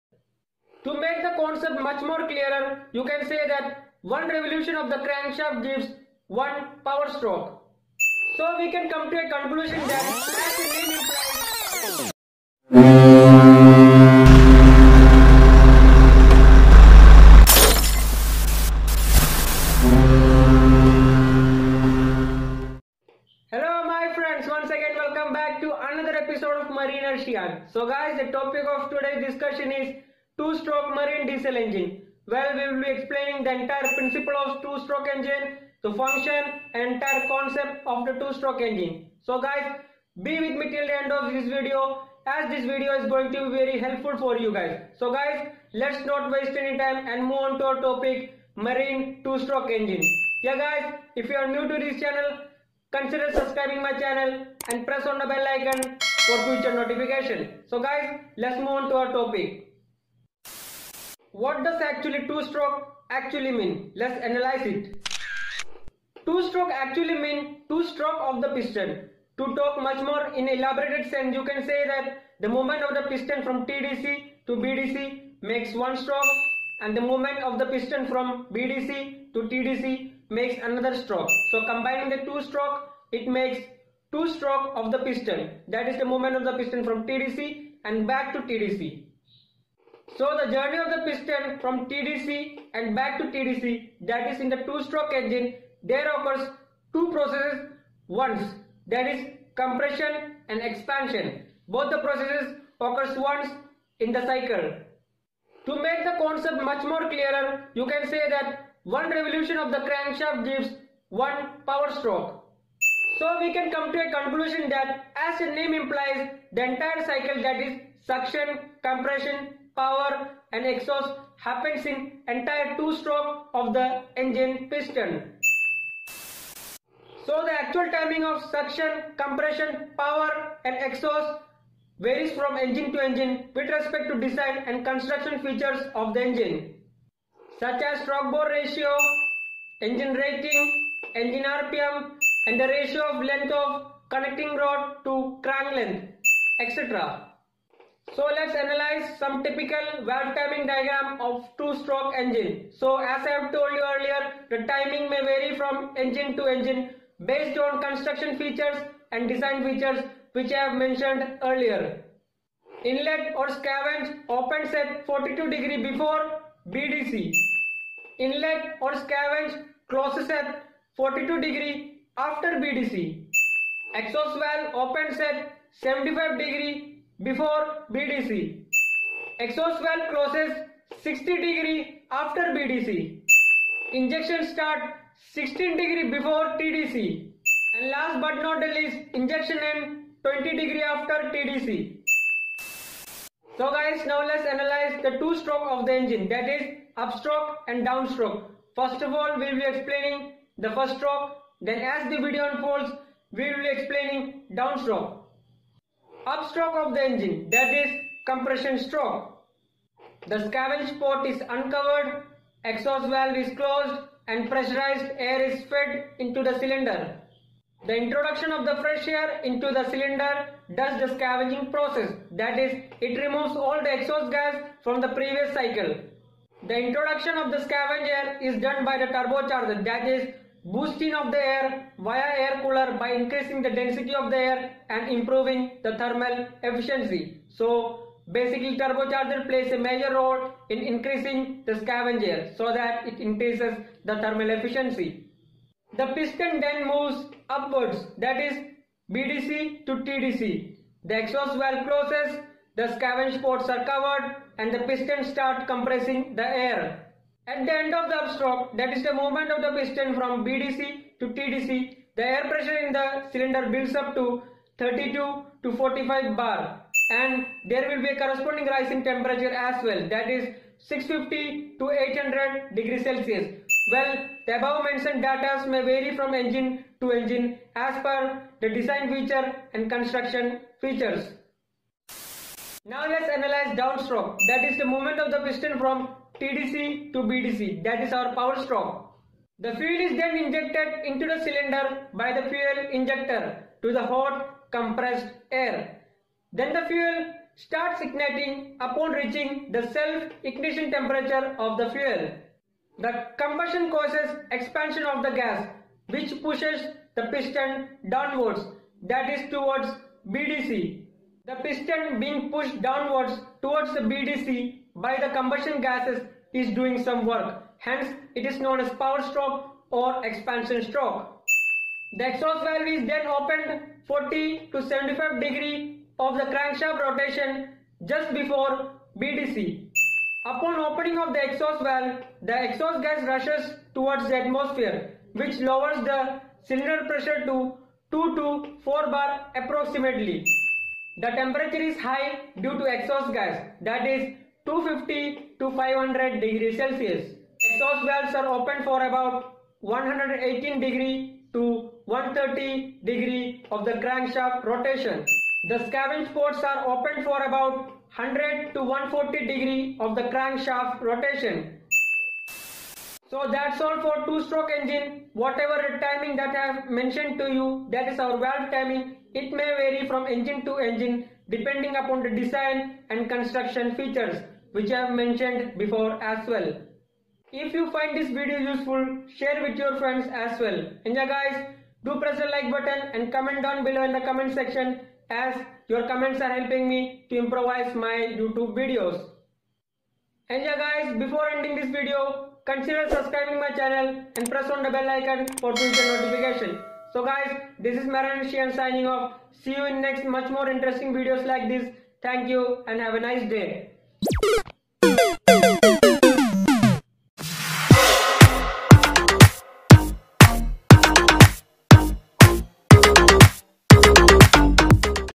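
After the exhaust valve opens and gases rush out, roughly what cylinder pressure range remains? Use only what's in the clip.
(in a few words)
2 to 4 bar.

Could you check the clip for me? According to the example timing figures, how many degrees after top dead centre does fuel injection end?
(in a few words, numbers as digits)
20 degrees.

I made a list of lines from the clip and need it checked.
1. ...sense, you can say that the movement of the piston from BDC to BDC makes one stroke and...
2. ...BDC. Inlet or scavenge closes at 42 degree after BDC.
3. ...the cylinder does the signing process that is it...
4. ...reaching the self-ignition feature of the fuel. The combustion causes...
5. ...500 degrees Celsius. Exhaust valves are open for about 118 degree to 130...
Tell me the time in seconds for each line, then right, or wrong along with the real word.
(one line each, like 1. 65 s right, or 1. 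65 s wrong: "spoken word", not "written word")
1. 71 s wrong: "TDC", not "BDC"
2. 166 s right
3. 219 s wrong: "scavenging", not "signing"
4. 299 s wrong: "temperature", not "feature"
5. 345 s right.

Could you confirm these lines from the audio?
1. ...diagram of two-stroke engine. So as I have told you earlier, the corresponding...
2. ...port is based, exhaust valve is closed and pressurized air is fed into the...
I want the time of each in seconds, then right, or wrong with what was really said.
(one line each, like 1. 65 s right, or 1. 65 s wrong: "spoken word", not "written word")
1. 150 s wrong: "timing", not "corresponding"
2. 210 s wrong: "uncovered", not "based".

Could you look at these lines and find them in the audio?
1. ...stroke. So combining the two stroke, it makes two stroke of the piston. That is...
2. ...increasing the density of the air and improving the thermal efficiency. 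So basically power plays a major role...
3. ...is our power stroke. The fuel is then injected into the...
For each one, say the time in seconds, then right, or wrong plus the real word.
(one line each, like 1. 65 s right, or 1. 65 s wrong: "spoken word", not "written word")
1. 80 s right
2. 233 s wrong: "turbocharger", not "power"
3. 288 s right.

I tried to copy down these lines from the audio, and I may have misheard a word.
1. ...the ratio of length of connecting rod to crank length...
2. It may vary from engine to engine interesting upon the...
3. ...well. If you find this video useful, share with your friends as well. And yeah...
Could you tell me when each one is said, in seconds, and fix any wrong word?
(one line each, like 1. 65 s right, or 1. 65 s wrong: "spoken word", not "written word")
1. 142 s right
2. 369 s wrong: "depending", not "interesting"
3. 376 s right.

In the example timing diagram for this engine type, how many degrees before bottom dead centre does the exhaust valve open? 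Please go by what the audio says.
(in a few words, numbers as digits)
75 degrees.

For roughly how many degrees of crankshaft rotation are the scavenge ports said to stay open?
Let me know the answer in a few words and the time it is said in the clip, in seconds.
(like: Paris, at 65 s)
100 to 140 degrees, at 358 s.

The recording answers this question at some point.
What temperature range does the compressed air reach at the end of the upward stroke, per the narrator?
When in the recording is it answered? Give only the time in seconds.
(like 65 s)
270 s.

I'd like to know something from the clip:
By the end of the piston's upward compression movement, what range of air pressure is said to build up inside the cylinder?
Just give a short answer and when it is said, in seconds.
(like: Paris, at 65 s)
32 to 45 bar, at 264 s.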